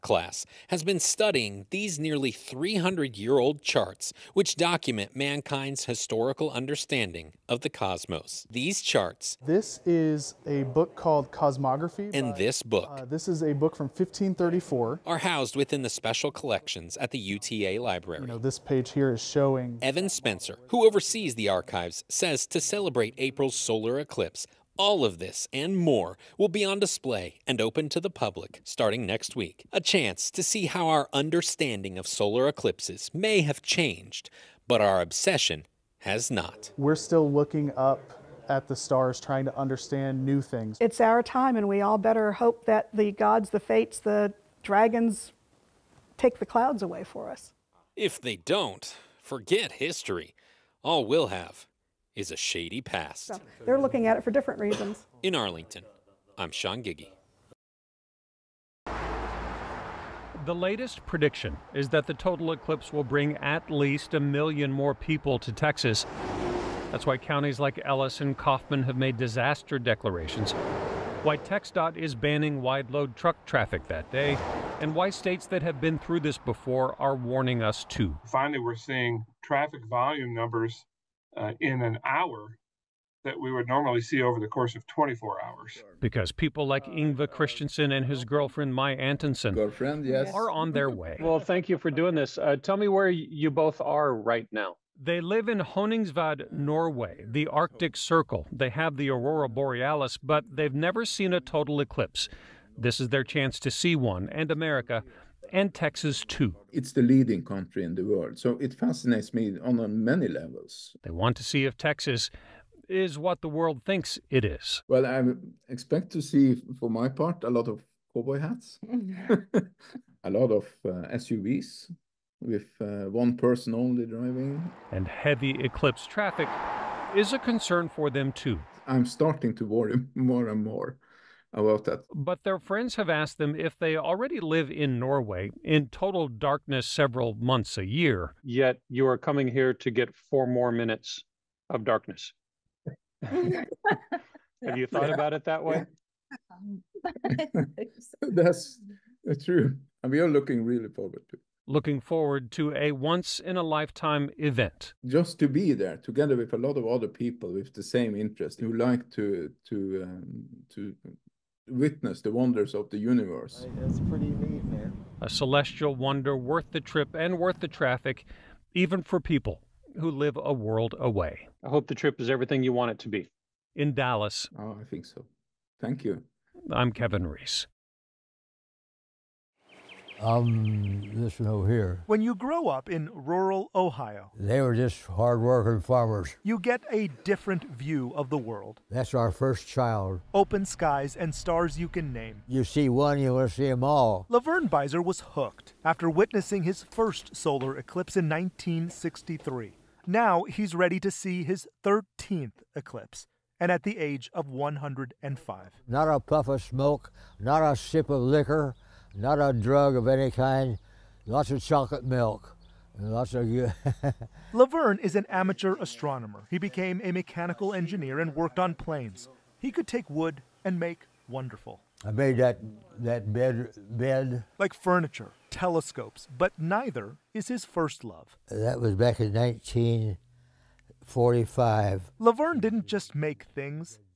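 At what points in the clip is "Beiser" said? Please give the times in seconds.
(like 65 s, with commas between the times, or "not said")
194 s.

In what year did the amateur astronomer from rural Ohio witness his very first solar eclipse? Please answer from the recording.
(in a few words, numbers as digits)
1963.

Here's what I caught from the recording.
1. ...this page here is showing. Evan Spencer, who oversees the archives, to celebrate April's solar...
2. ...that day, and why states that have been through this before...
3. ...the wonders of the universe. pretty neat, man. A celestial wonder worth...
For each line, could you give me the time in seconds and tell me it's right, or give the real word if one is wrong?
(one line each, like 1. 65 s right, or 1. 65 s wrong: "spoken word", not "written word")
1. 18 s right
2. 73 s right
3. 162 s right.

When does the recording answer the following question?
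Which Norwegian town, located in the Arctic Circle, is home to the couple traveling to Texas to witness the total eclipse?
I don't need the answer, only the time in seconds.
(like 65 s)
95 s.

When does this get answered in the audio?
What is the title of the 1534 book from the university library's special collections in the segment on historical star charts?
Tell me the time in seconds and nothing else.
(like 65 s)
11 s.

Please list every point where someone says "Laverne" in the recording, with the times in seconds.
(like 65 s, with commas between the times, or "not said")
194 s, 214 s, 232 s.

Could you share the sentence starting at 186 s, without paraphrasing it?
You get a different view of the world.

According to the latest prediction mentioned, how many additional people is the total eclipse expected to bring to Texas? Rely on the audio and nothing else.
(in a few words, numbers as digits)
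1 million.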